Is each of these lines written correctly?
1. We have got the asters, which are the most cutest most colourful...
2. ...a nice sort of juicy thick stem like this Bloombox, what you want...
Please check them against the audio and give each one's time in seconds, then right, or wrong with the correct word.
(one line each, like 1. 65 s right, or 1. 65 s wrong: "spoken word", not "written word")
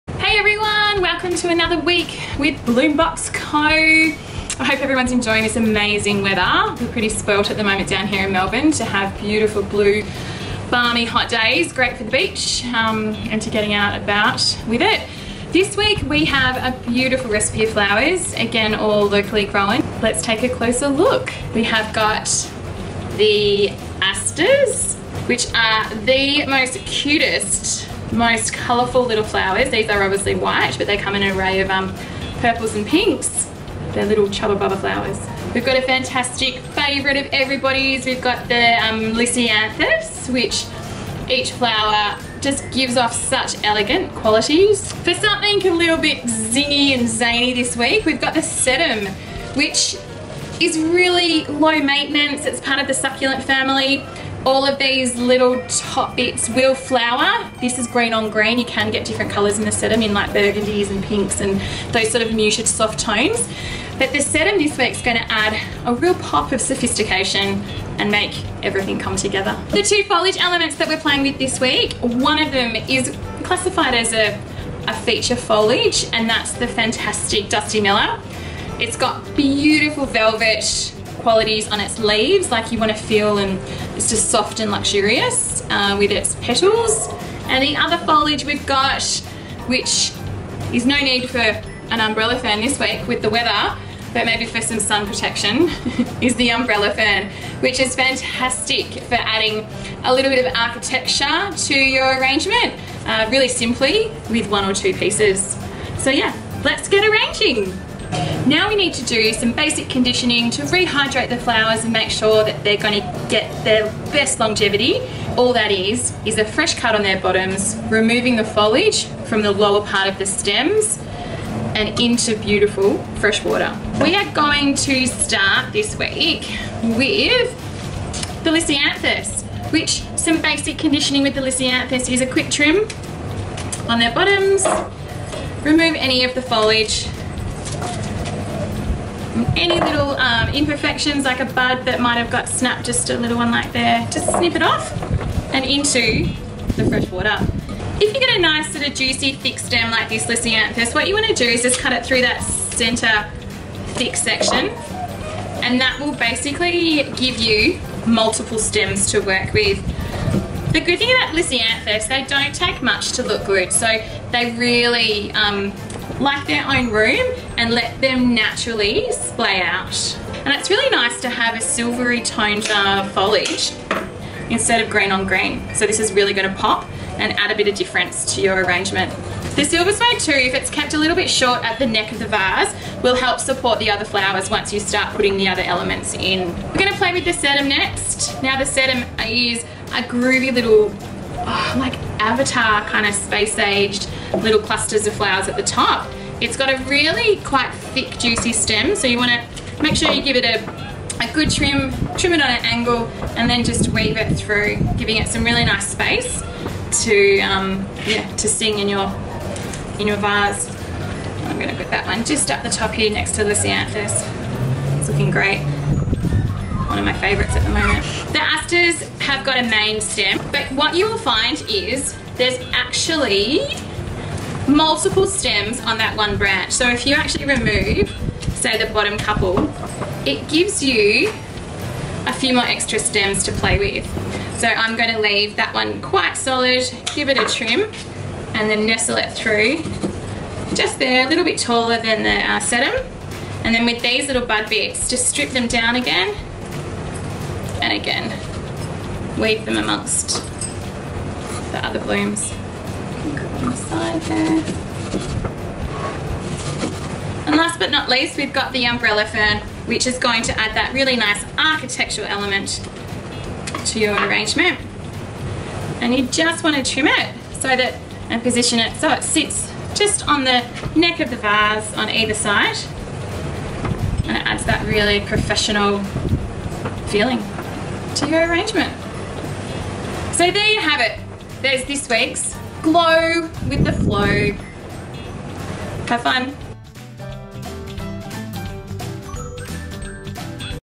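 1. 21 s right
2. 148 s wrong: "Lisianthus", not "Bloombox".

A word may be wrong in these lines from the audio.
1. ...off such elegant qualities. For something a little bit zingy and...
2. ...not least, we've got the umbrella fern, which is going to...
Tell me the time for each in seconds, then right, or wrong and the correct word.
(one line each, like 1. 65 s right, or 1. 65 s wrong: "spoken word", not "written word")
1. 42 s right
2. 257 s right.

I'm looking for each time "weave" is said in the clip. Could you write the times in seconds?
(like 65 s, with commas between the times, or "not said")
203 s, 249 s.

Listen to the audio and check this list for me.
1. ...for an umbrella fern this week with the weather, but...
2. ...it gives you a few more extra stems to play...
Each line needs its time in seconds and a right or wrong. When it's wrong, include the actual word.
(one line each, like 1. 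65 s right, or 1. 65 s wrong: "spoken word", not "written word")
1. 91 s right
2. 230 s right.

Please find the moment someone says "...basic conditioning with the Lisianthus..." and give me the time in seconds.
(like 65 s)
130 s.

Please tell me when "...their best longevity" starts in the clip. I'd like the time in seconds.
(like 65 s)
113 s.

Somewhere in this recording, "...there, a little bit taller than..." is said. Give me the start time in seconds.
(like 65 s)
240 s.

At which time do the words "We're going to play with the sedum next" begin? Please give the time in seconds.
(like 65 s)
186 s.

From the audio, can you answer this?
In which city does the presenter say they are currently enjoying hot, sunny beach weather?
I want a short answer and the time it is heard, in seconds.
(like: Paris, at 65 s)
Melbourne, at 8 s.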